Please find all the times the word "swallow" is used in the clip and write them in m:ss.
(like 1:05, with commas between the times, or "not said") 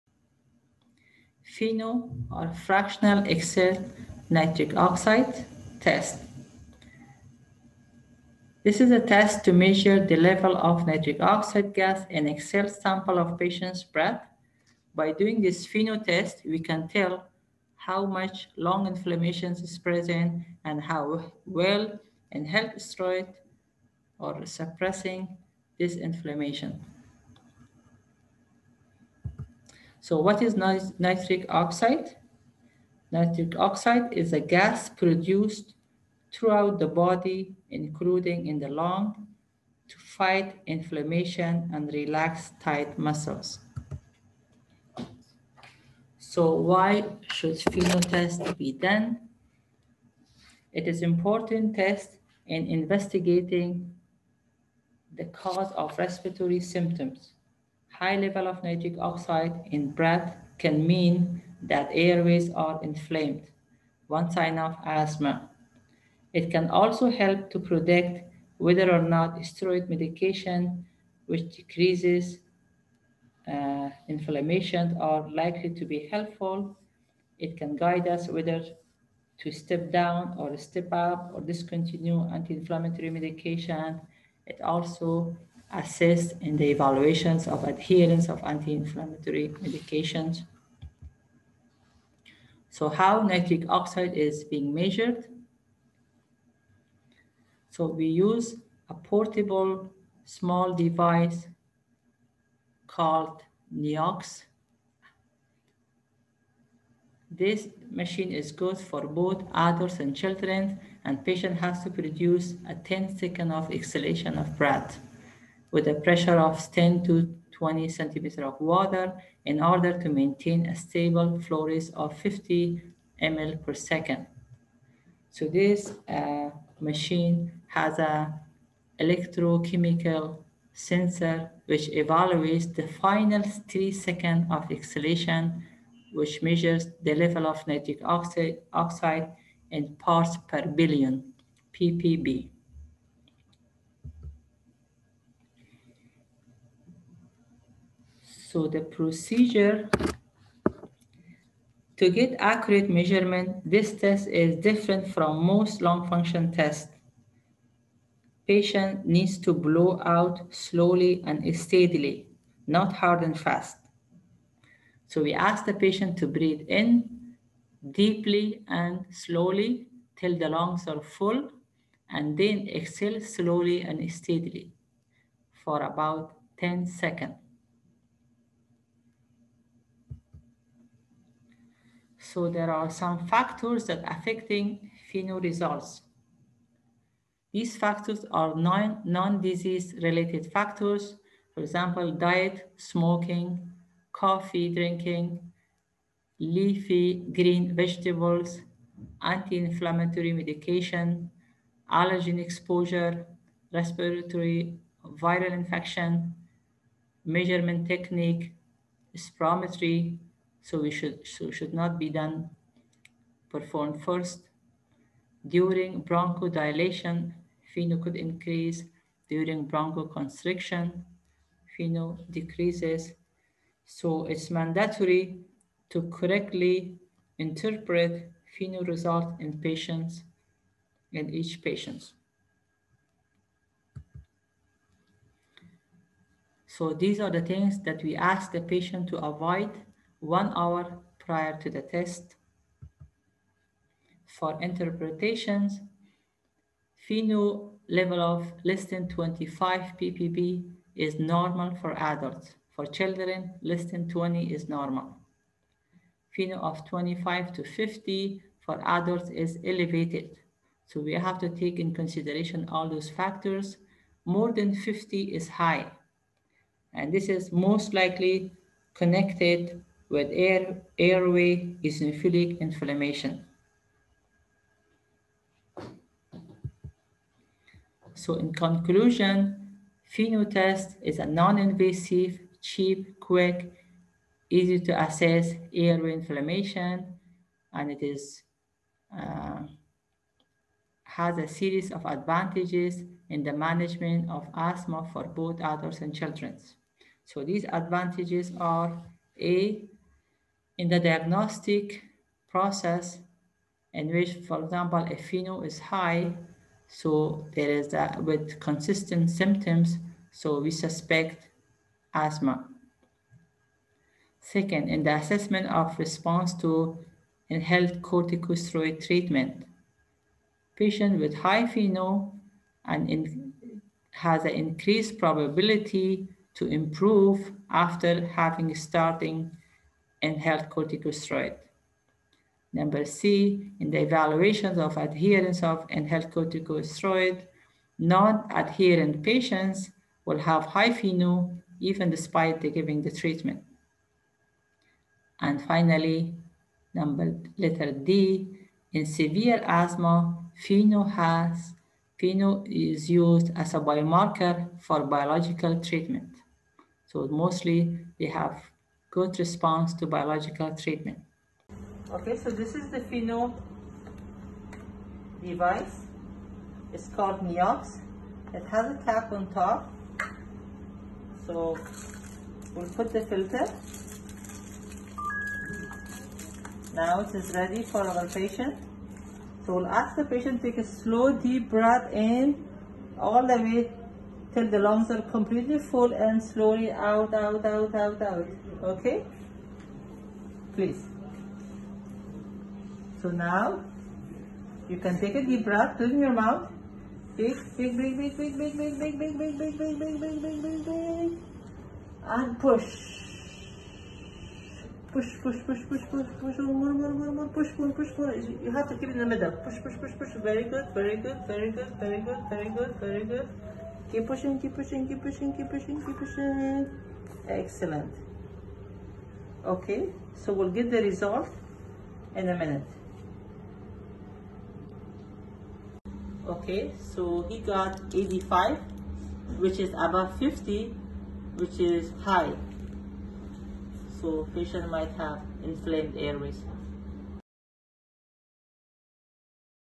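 not said.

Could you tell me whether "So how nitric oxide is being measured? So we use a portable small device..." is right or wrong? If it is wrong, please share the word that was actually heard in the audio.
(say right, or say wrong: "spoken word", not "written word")
right.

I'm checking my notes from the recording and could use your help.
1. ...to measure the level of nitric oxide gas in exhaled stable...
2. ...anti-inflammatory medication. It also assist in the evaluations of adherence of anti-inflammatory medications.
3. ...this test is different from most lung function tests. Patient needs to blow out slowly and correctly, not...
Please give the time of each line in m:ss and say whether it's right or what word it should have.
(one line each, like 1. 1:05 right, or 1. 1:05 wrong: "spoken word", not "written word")
1. 0:09 wrong: "sample", not "stable"
2. 1:22 right
3. 2:33 wrong: "steadily", not "correctly".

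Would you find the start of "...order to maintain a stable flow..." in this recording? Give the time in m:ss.
1:59.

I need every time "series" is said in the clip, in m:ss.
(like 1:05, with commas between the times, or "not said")
4:51.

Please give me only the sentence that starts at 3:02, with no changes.
So there are some factors that affecting final results.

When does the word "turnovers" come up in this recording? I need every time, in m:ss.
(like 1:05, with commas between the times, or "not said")
not said.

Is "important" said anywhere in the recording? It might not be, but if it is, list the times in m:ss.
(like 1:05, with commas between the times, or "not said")
0:51.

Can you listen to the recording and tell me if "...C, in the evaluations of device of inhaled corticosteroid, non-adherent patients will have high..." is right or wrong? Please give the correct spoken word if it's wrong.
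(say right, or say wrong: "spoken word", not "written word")
wrong: "adherence", not "device".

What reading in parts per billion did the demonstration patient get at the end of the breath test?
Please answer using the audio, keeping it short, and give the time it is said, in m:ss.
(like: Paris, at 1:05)
85, at 7:08.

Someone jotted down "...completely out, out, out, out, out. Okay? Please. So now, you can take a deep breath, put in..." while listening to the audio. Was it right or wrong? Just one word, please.
wrong.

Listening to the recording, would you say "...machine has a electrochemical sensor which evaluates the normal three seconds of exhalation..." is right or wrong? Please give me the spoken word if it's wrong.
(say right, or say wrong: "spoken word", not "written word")
wrong: "final", not "normal".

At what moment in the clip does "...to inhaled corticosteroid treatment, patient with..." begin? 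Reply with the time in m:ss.
5:16.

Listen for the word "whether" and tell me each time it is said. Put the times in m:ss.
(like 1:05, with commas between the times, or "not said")
1:08, 1:18.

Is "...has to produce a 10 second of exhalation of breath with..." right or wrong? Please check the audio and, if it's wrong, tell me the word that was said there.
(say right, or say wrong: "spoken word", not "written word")
right.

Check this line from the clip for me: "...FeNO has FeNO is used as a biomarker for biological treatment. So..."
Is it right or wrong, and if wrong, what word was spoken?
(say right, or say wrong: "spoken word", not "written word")
right.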